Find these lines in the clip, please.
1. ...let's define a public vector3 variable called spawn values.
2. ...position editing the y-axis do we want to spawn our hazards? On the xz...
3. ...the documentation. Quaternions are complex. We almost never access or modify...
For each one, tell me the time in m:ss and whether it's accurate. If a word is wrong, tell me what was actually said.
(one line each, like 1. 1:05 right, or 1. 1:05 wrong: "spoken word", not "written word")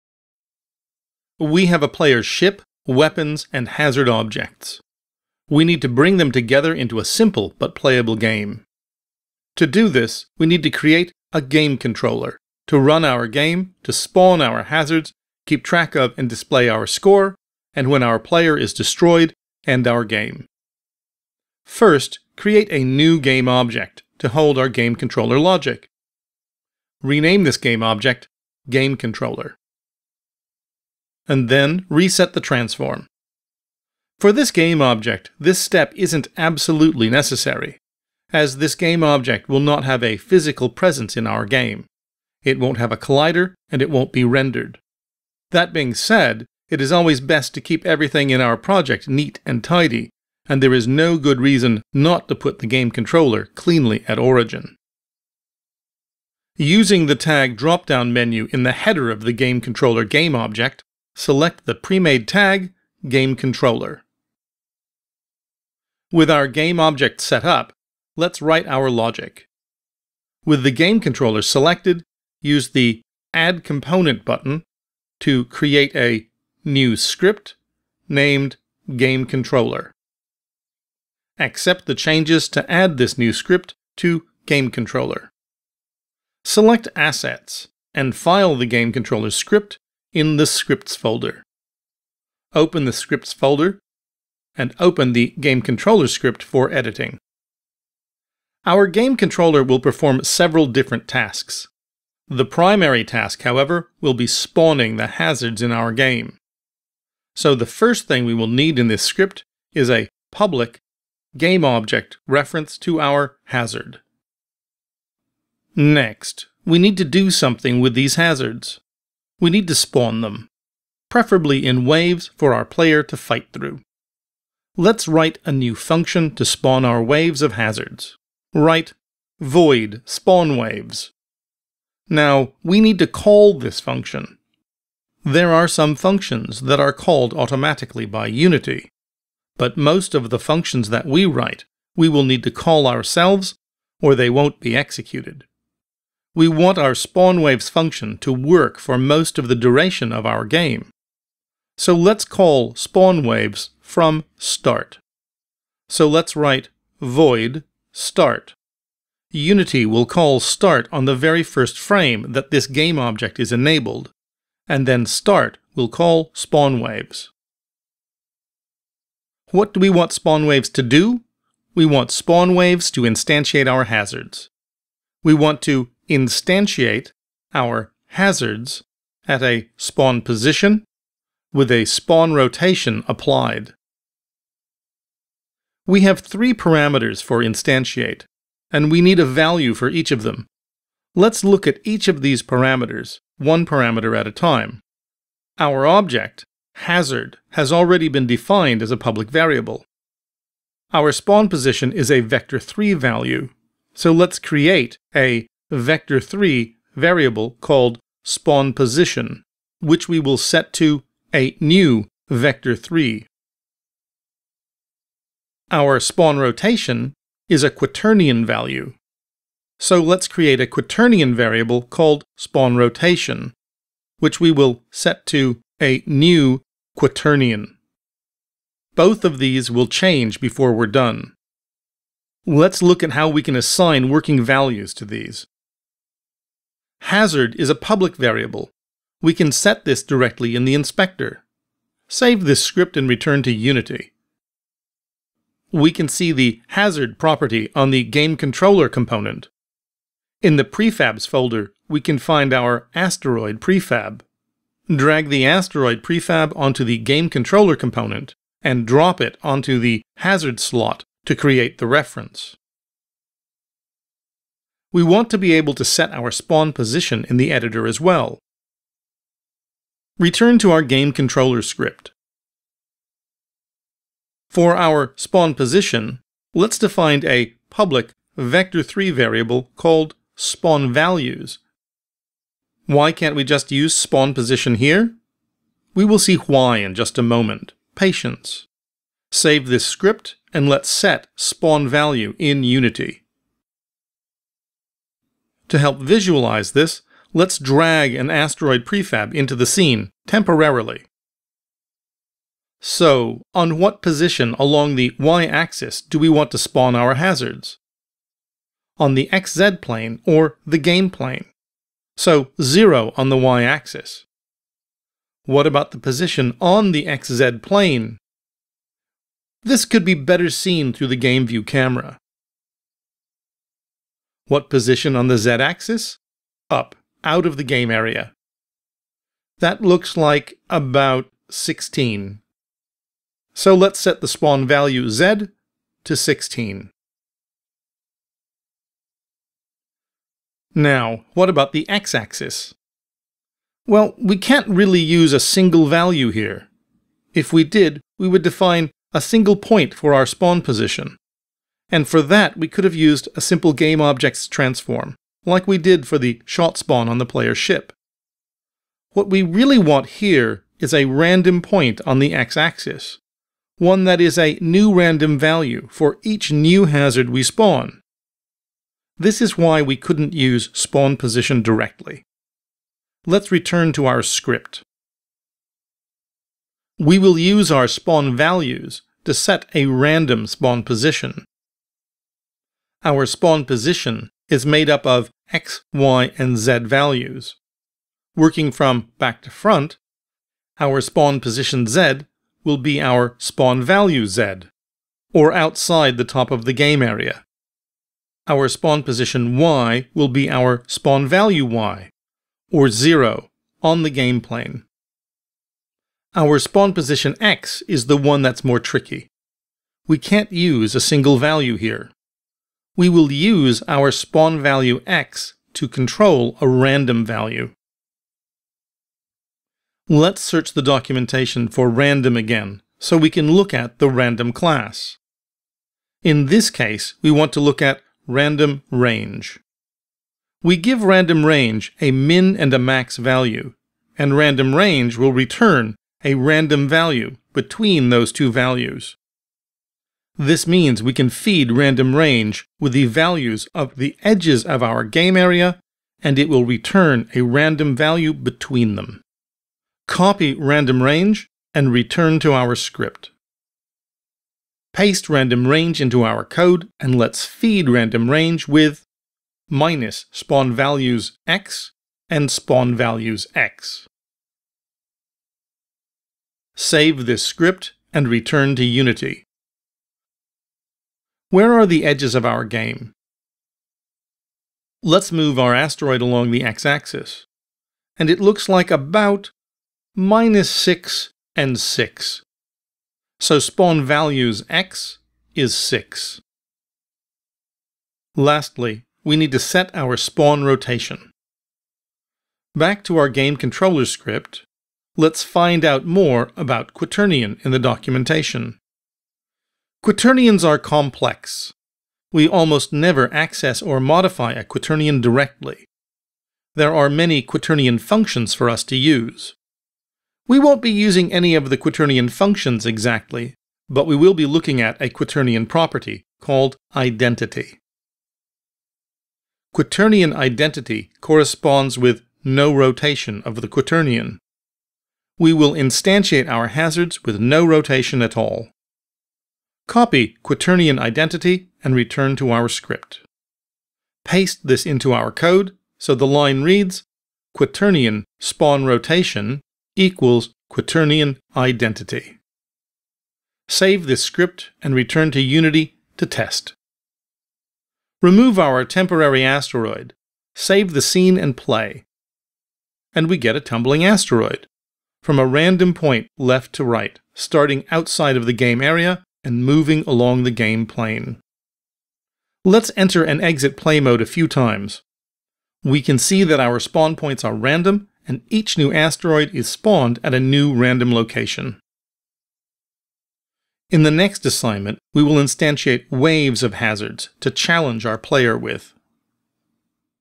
1. 4:36 right
2. 5:04 wrong: "along", not "editing"
3. 8:17 right.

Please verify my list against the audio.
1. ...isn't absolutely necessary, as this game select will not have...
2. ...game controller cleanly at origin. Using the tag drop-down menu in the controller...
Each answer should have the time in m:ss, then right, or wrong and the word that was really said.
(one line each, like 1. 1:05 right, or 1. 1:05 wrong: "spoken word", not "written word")
1. 0:35 wrong: "object", not "select"
2. 0:52 wrong: "header", not "controller".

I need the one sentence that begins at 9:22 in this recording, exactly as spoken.
Let's enter and exit play mode a few times.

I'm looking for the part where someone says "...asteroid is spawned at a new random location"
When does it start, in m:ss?
9:28.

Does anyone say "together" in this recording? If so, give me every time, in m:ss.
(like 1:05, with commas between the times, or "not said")
0:06.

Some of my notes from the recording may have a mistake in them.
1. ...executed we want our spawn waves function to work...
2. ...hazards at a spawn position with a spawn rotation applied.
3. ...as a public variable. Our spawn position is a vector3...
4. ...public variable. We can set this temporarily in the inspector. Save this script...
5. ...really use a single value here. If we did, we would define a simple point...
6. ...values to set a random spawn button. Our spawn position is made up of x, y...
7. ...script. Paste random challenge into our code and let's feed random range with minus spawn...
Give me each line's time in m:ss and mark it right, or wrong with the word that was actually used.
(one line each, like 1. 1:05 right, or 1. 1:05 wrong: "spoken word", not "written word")
1. 2:24 right
2. 2:58 right
3. 3:18 right
4. 3:57 wrong: "directly", not "temporarily"
5. 5:44 wrong: "single", not "simple"
6. 6:18 wrong: "position", not "button"
7. 7:32 wrong: "range", not "challenge".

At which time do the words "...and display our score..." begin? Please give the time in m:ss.
0:16.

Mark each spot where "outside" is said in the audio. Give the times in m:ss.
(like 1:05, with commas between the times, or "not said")
6:35, 9:17.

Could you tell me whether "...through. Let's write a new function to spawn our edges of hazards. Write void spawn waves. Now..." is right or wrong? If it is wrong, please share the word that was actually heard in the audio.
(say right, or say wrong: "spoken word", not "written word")
wrong: "waves", not "edges".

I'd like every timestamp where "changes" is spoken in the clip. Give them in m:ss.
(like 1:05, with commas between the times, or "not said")
1:21, 3:49.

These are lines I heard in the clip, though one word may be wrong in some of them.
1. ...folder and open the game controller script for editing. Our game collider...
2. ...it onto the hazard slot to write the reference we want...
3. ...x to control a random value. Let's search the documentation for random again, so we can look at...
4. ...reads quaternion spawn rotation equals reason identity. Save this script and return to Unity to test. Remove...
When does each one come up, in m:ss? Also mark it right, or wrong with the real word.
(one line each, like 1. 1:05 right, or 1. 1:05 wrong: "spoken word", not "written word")
1. 1:33 wrong: "controller", not "collider"
2. 4:19 wrong: "create", not "write"
3. 6:55 right
4. 8:56 wrong: "quaternion", not "reason".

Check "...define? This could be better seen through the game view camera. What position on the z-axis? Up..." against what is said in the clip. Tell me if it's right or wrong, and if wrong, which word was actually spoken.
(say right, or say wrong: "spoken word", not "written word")
wrong: "plane", not "define".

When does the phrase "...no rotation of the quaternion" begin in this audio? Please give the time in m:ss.
8:42.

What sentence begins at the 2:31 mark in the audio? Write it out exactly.
So let's call spawn waves from start.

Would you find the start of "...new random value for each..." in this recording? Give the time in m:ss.
6:04.